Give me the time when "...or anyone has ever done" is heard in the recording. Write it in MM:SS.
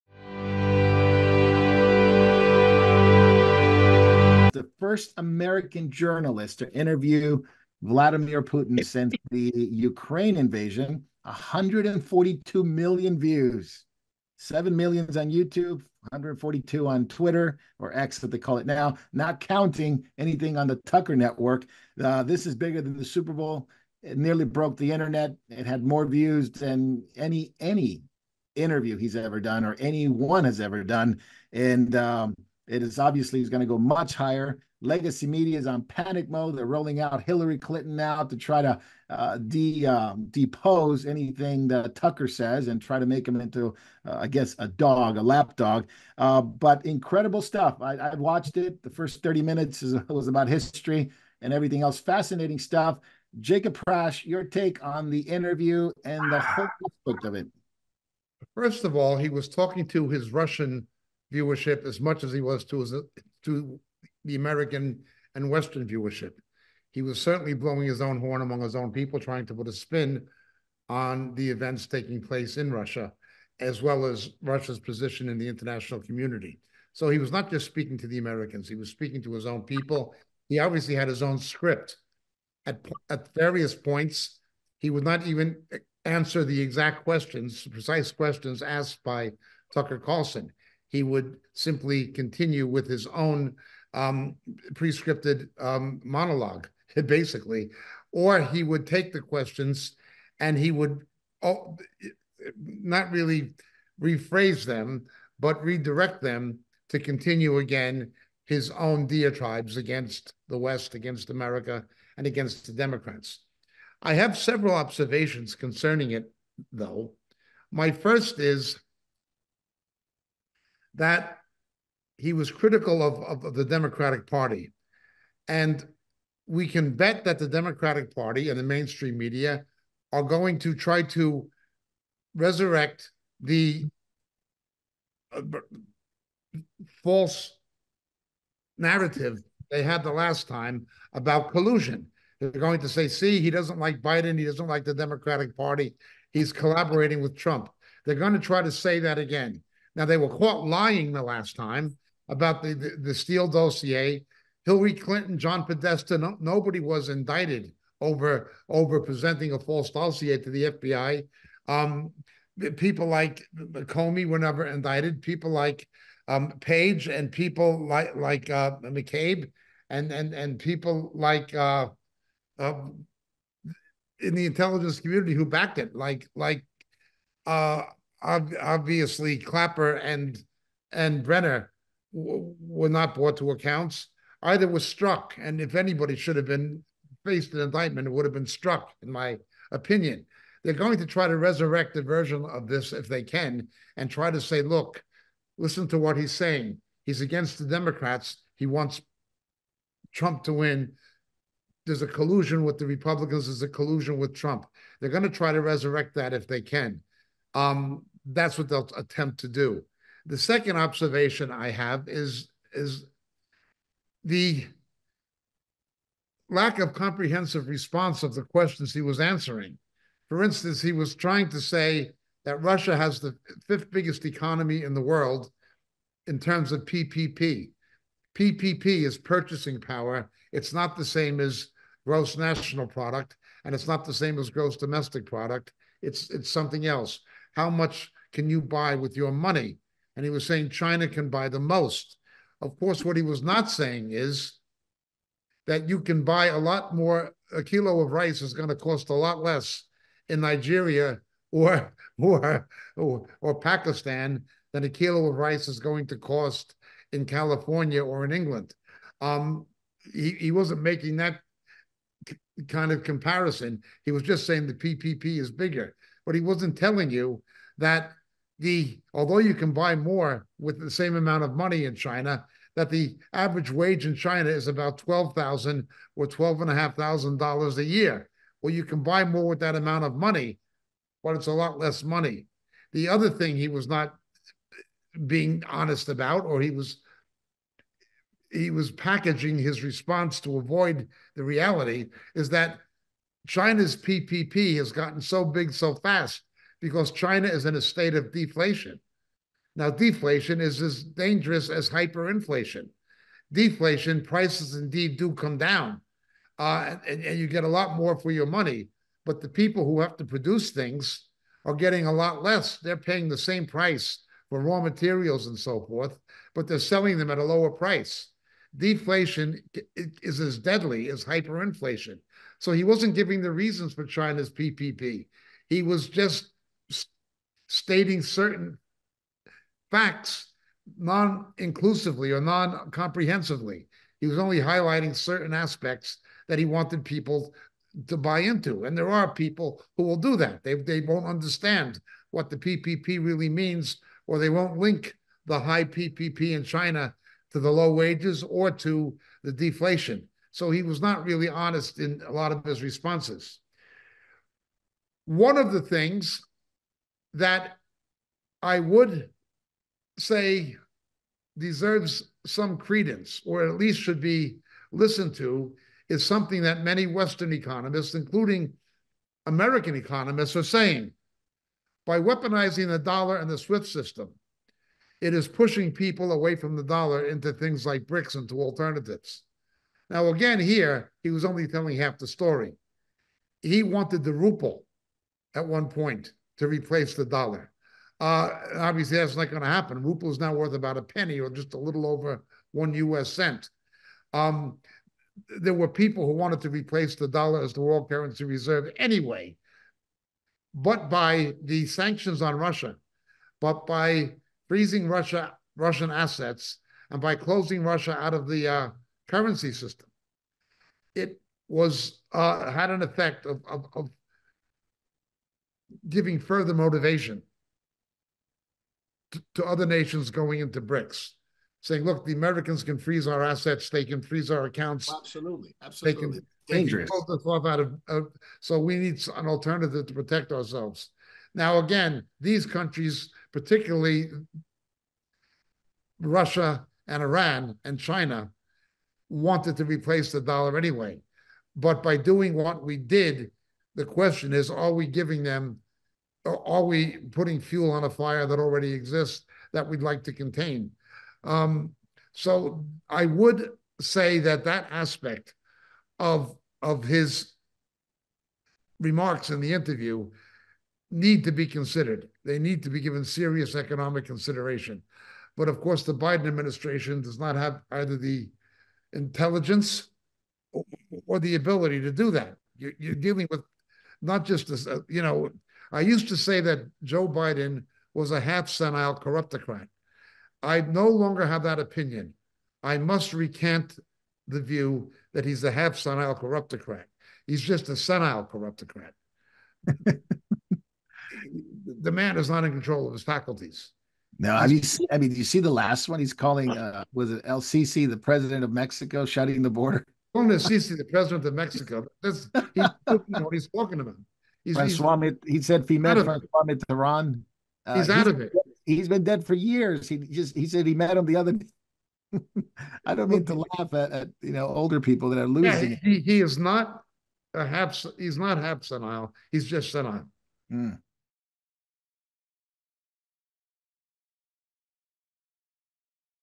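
00:29.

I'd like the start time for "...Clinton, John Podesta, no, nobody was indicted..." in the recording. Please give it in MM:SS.
02:34.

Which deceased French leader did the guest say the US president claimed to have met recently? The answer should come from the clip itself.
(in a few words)
Francois Mitterrand.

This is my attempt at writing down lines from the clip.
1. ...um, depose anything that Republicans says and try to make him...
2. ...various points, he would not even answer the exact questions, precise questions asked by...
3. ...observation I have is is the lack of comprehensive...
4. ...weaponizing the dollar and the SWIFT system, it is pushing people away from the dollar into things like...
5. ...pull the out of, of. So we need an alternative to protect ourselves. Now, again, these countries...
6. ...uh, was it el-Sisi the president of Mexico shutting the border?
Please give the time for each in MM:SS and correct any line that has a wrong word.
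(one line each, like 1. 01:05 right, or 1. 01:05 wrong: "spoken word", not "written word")
1. 00:39 wrong: "Tucker", not "Republicans"
2. 01:23 right
3. 03:30 right
4. 06:12 right
5. 07:07 right
6. 08:16 right.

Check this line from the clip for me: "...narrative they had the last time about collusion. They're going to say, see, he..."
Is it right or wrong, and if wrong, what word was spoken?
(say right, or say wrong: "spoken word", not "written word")
right.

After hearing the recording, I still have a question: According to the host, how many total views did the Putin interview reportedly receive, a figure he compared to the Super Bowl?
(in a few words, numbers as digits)
142 million.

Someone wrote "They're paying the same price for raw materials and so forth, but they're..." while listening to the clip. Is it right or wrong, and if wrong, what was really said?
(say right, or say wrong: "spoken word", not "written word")
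right.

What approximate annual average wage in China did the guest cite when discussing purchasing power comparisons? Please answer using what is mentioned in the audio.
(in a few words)
$12,000.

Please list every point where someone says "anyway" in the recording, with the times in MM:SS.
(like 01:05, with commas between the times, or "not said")
06:38, 07:20.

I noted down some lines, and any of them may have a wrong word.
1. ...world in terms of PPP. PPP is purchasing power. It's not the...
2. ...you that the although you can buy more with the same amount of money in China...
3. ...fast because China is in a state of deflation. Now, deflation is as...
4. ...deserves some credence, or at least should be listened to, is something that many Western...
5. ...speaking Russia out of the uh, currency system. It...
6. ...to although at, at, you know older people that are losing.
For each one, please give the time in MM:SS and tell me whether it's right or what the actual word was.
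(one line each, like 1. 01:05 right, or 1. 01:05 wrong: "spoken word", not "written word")
1. 03:45 right
2. 04:27 right
3. 04:55 right
4. 06:01 right
5. 06:47 wrong: "closing", not "speaking"
6. 08:33 wrong: "laugh", not "although".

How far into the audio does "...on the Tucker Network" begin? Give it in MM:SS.
00:20.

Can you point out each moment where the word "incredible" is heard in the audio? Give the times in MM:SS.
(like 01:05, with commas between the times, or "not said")
00:46.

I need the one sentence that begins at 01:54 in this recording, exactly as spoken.
I have several observations concerning it, though.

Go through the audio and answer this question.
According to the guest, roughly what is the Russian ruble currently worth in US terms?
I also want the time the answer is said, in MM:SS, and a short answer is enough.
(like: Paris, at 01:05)
About a penny, at 06:30.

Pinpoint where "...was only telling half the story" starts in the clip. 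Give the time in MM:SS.
06:21.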